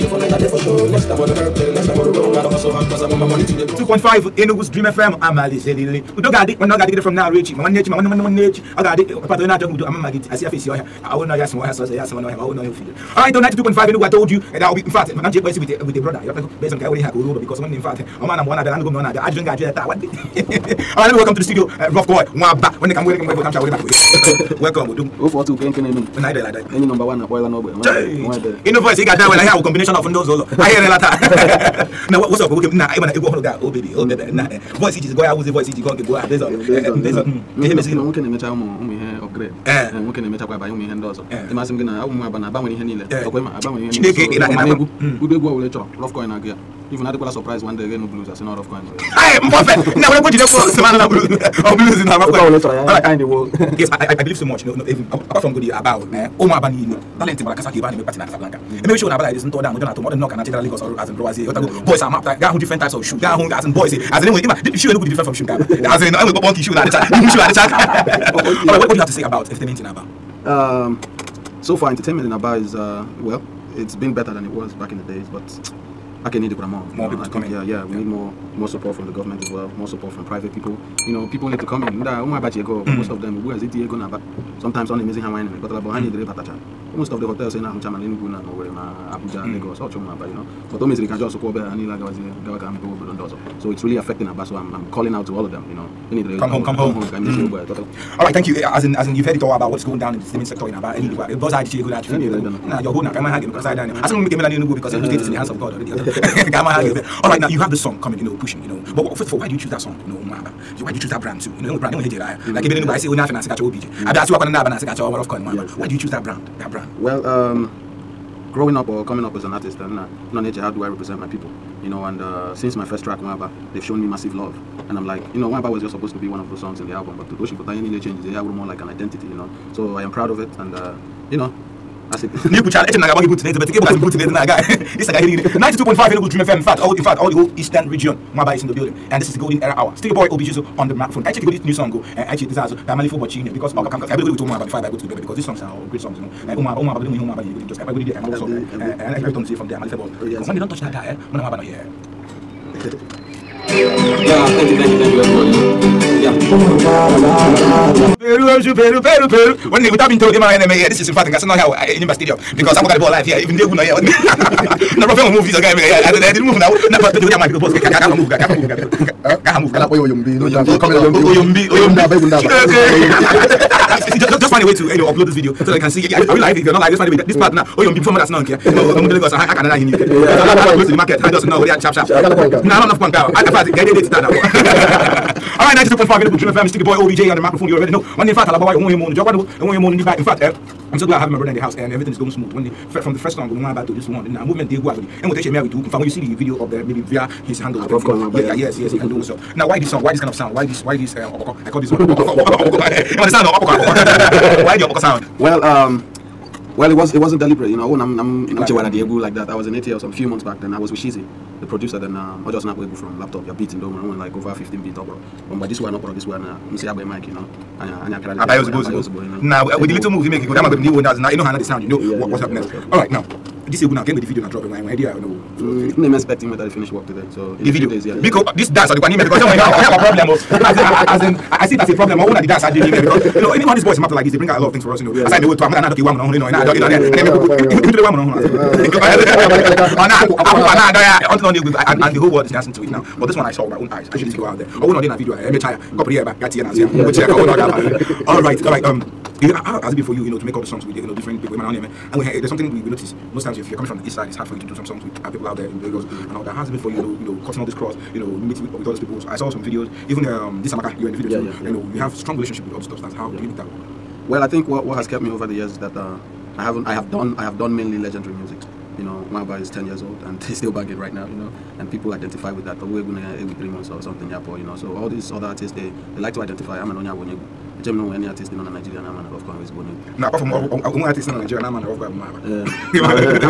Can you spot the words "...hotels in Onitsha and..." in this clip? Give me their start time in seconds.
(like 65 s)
87 s.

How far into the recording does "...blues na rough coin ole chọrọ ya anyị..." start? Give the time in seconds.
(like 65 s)
51 s.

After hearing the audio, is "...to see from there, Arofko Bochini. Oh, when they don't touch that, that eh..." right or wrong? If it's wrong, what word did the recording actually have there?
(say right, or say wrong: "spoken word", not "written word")
wrong: "Kamalifo", not "Arofko".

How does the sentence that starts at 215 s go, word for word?
Um, but this one opera, this one, uh, msi agba mic, you know.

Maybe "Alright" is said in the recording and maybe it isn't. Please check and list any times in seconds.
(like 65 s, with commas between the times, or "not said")
13 s, 19 s.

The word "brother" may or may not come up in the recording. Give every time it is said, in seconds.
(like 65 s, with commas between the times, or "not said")
16 s, 191 s.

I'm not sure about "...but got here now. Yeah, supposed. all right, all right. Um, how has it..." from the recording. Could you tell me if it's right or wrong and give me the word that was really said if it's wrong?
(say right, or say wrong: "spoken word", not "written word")
wrong: "happened", not "supposed".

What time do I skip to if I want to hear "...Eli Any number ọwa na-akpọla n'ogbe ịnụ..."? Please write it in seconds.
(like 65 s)
26 s.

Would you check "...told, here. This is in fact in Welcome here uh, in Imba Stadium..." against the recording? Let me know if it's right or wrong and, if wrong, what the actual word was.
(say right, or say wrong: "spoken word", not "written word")
wrong: "Gasana", not "Welcome".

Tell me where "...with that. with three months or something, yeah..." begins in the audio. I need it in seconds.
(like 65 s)
272 s.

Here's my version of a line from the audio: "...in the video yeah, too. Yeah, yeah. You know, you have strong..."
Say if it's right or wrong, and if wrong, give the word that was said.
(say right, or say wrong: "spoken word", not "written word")
right.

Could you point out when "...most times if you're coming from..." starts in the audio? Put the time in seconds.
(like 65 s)
253 s.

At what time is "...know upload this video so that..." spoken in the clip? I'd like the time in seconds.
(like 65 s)
174 s.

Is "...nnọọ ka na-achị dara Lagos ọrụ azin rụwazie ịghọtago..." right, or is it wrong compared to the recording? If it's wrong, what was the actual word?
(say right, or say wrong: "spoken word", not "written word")
right.